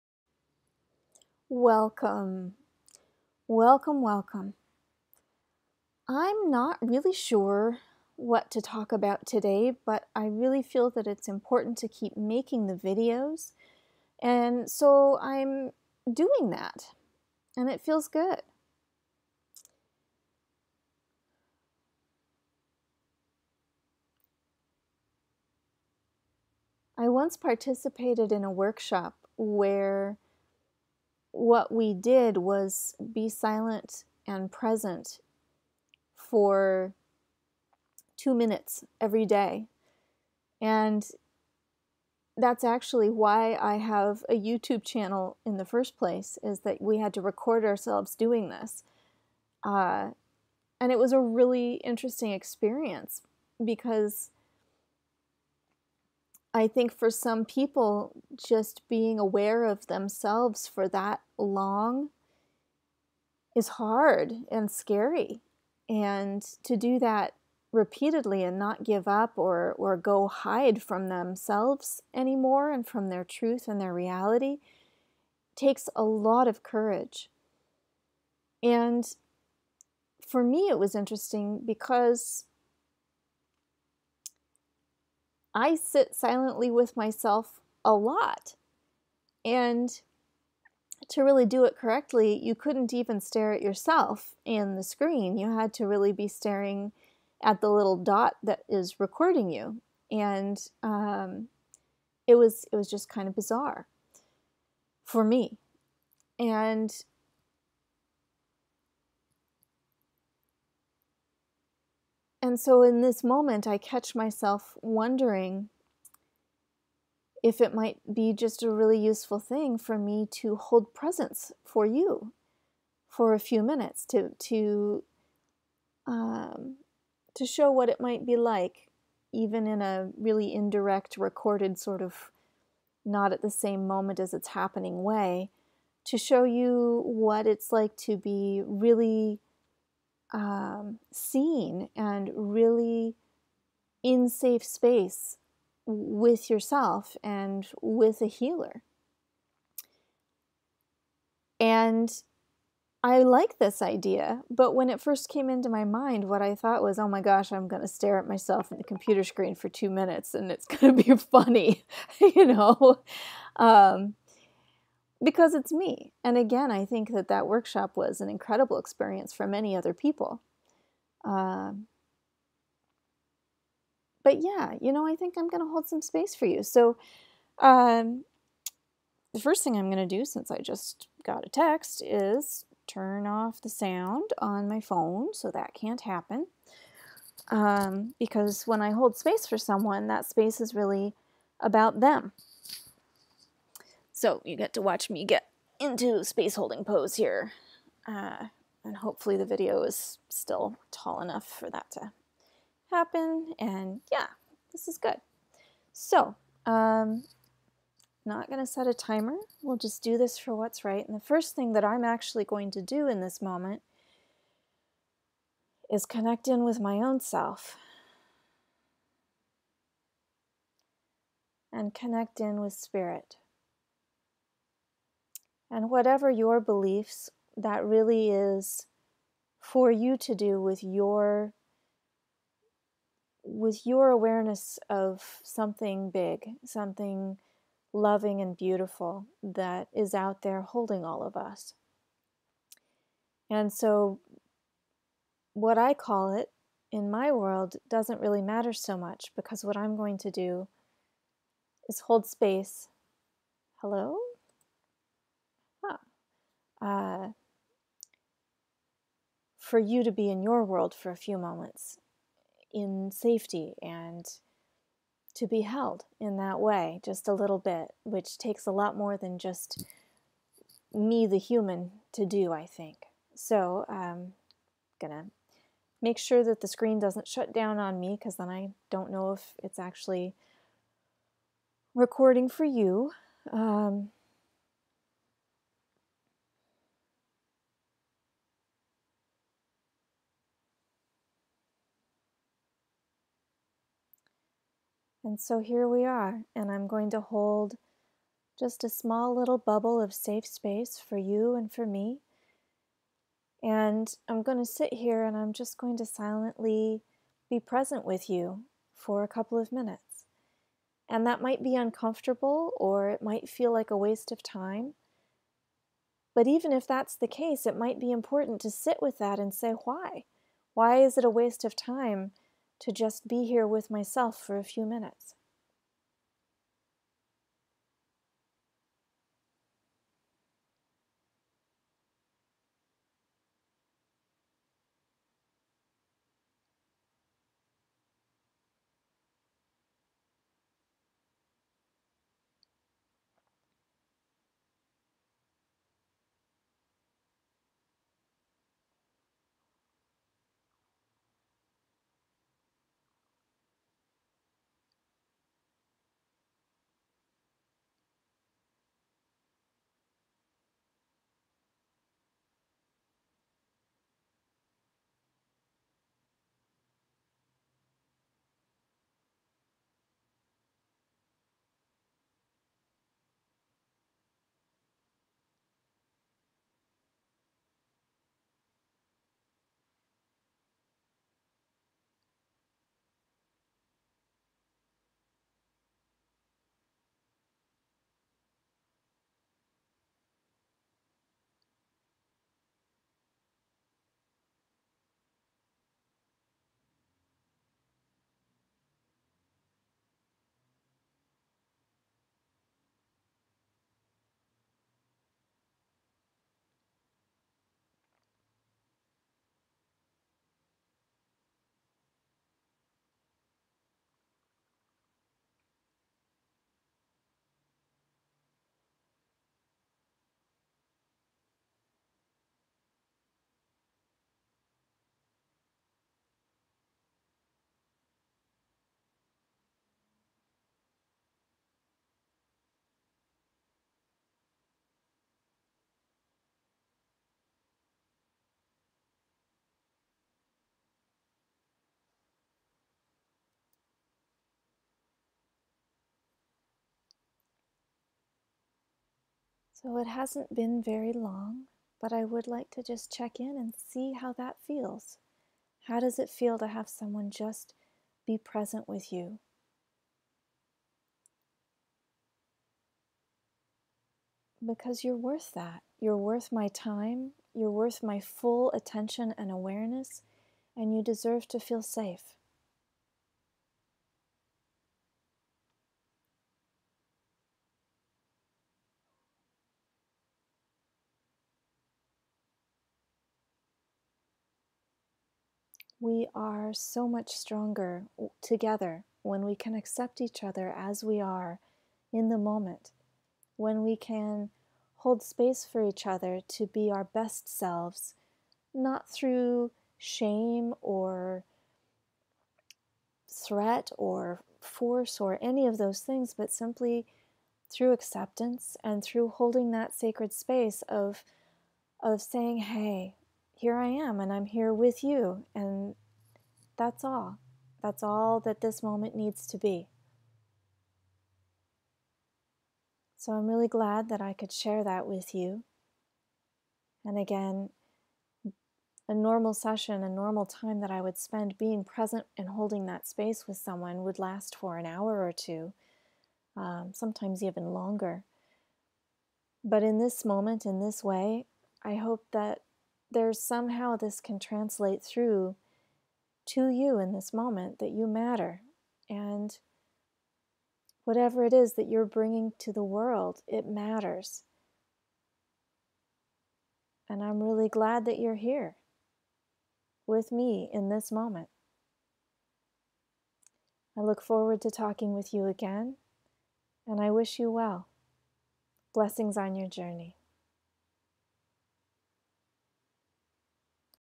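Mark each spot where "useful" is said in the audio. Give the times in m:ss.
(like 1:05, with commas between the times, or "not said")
1:58.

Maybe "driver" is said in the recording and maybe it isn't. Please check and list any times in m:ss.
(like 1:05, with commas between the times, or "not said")
not said.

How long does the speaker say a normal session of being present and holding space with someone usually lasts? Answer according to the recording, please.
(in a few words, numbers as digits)
an hour or two.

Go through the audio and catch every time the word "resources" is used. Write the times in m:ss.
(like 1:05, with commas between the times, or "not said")
not said.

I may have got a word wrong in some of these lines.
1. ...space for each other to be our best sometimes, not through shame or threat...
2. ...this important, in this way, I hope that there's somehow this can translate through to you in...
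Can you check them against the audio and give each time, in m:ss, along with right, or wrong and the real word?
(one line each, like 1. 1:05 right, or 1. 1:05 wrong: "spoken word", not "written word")
1. 8:15 wrong: "selves", not "sometimes"
2. 8:59 wrong: "moment", not "important".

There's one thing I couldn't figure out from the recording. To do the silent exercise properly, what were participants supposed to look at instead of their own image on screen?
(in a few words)
the little dot.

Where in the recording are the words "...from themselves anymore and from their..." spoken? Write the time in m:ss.
1:10.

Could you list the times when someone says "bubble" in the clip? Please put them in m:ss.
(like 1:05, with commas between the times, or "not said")
4:59.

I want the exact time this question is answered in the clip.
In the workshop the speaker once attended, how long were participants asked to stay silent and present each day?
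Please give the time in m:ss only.
0:38.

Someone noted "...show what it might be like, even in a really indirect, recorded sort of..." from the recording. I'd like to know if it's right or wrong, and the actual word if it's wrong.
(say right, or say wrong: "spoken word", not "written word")
right.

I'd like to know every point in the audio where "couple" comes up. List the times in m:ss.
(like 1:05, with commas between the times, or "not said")
5:09.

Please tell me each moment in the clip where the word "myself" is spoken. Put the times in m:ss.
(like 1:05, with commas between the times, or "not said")
1:26, 1:54, 2:38, 5:23.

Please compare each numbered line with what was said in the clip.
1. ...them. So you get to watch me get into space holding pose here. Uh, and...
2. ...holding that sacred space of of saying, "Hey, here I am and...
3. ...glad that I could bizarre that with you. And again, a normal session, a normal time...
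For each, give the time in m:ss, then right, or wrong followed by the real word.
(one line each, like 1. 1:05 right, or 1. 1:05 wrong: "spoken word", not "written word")
1. 3:11 right
2. 8:29 right
3. 8:43 wrong: "share", not "bizarre".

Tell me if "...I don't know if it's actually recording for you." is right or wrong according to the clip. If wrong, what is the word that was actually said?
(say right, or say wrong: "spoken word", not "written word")
right.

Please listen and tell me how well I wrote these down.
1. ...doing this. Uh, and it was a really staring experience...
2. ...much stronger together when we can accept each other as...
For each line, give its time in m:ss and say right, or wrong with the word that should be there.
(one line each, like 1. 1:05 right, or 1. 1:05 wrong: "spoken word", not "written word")
1. 0:48 wrong: "interesting", not "staring"
2. 8:07 right.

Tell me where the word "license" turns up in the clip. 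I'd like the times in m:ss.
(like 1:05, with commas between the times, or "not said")
not said.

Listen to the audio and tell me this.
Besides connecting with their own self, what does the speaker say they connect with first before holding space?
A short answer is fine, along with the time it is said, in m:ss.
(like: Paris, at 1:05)
spirit, at 3:42.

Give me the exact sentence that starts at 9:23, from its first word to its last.
I look forward to talking with you again, and I wish you well.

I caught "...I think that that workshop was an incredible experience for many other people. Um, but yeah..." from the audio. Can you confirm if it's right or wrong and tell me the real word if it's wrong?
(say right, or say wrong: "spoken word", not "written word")
right.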